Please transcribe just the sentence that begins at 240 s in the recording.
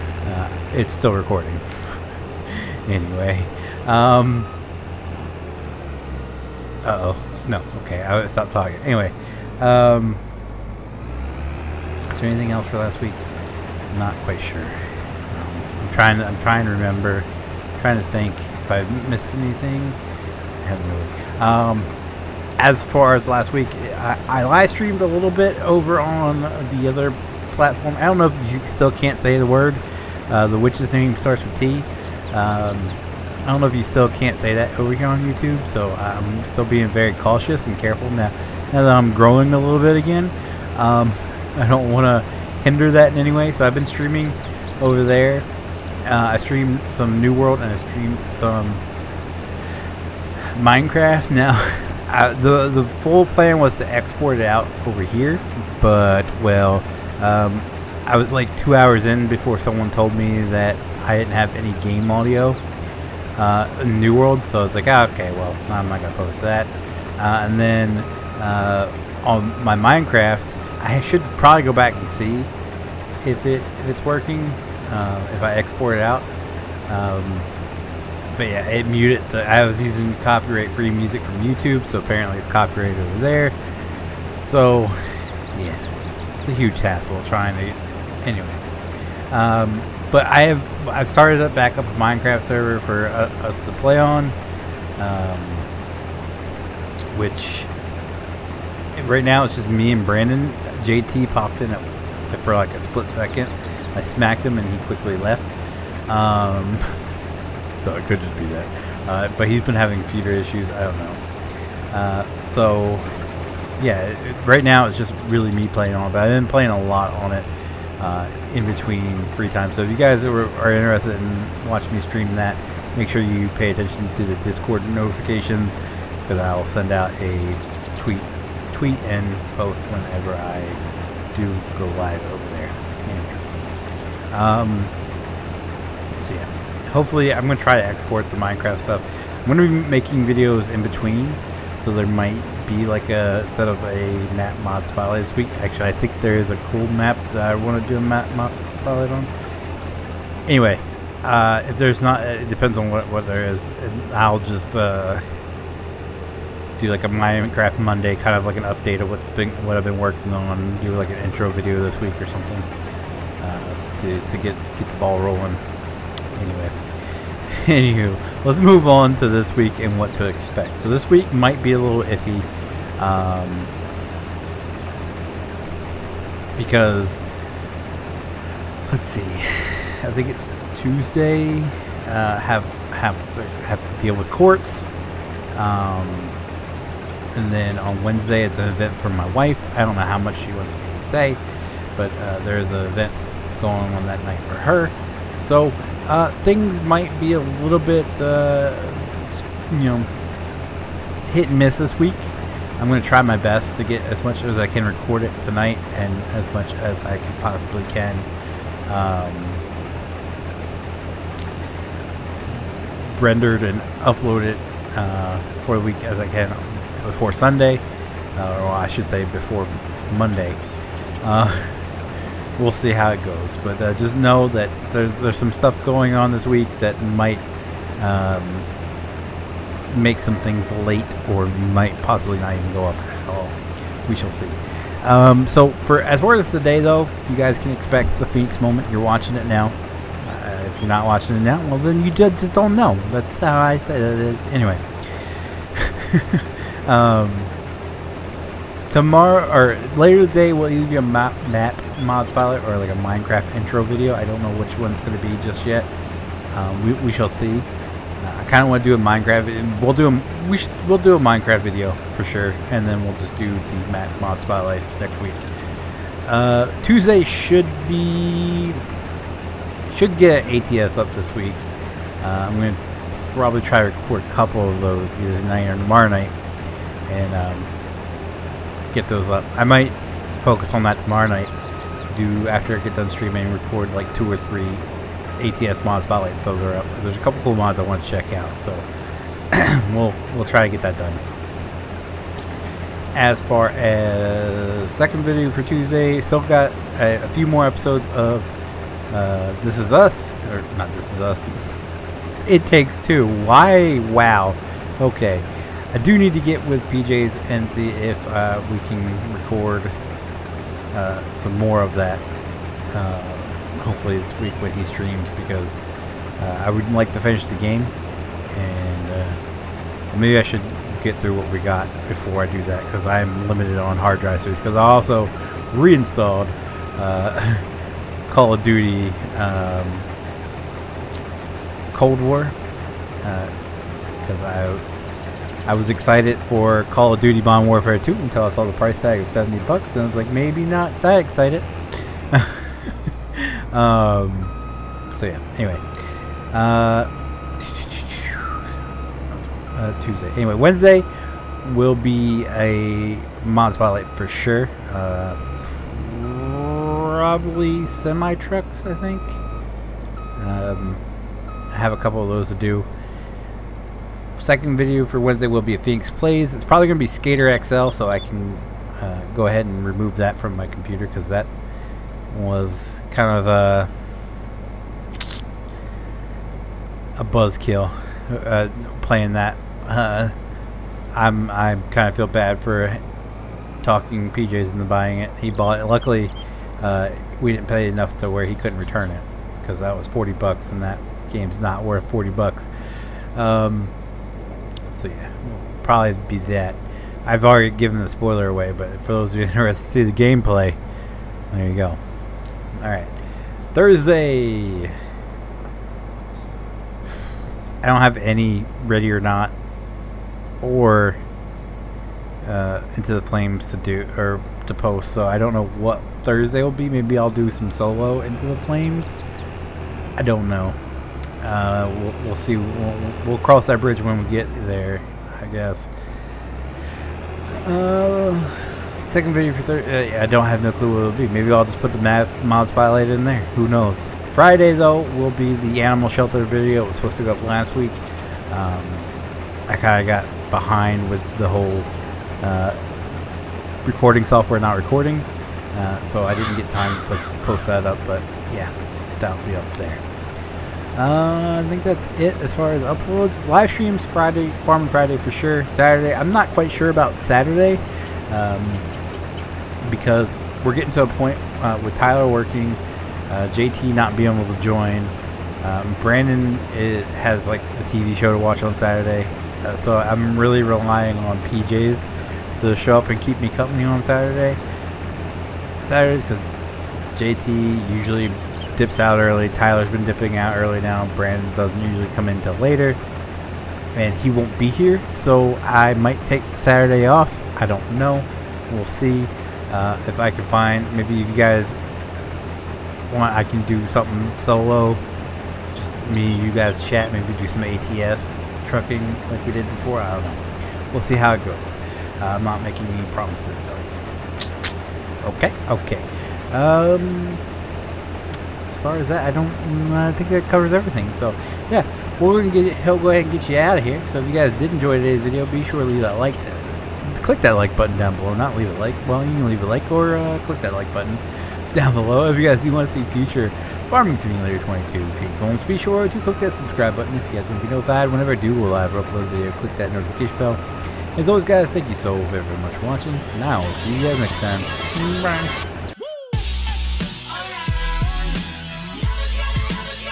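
Uh, if you're not watching it now, well then you just don't know.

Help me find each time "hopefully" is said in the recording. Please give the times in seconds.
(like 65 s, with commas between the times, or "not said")
136 s, 313 s.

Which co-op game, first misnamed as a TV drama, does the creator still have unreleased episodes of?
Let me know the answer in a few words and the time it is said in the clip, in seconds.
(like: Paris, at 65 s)
It Takes Two, at 302 s.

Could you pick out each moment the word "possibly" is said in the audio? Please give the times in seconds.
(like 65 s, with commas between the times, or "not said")
207 s, 232 s.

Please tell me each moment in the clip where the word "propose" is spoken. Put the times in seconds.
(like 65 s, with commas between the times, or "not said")
not said.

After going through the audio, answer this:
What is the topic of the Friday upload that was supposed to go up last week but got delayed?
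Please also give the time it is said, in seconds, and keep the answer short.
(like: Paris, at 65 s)
animal shelter, at 435 s.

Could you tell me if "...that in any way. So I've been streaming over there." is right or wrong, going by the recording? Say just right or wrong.
right.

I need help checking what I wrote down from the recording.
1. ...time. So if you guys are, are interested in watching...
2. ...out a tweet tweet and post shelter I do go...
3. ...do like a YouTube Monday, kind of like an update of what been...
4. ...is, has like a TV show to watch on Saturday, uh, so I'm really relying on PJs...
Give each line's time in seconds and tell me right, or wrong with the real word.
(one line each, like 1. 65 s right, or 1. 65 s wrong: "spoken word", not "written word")
1. 119 s right
2. 126 s wrong: "whenever", not "shelter"
3. 156 s wrong: "Minecraft", not "YouTube"
4. 466 s right.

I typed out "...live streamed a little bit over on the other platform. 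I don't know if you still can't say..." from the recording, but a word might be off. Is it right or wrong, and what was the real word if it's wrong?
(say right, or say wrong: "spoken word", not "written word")
right.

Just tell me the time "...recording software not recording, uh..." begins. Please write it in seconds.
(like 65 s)
443 s.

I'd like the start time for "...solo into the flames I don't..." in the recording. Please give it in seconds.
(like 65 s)
417 s.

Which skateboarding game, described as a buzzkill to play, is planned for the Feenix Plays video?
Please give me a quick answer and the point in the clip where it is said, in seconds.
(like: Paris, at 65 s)
Skater XL, at 367 s.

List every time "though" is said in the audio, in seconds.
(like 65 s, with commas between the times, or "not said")
236 s, 434 s, 503 s.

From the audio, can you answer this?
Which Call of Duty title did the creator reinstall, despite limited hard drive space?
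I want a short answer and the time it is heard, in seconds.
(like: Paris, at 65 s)
Cold War, at 331 s.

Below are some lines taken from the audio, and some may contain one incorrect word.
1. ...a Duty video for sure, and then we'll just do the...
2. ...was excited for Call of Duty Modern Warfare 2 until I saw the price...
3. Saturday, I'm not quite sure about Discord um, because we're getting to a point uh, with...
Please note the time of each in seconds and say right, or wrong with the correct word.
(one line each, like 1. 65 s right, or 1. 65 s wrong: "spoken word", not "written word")
1. 261 s wrong: "Minecraft", not "Duty"
2. 335 s right
3. 455 s wrong: "Saturday", not "Discord".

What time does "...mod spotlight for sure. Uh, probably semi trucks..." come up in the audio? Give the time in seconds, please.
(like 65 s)
353 s.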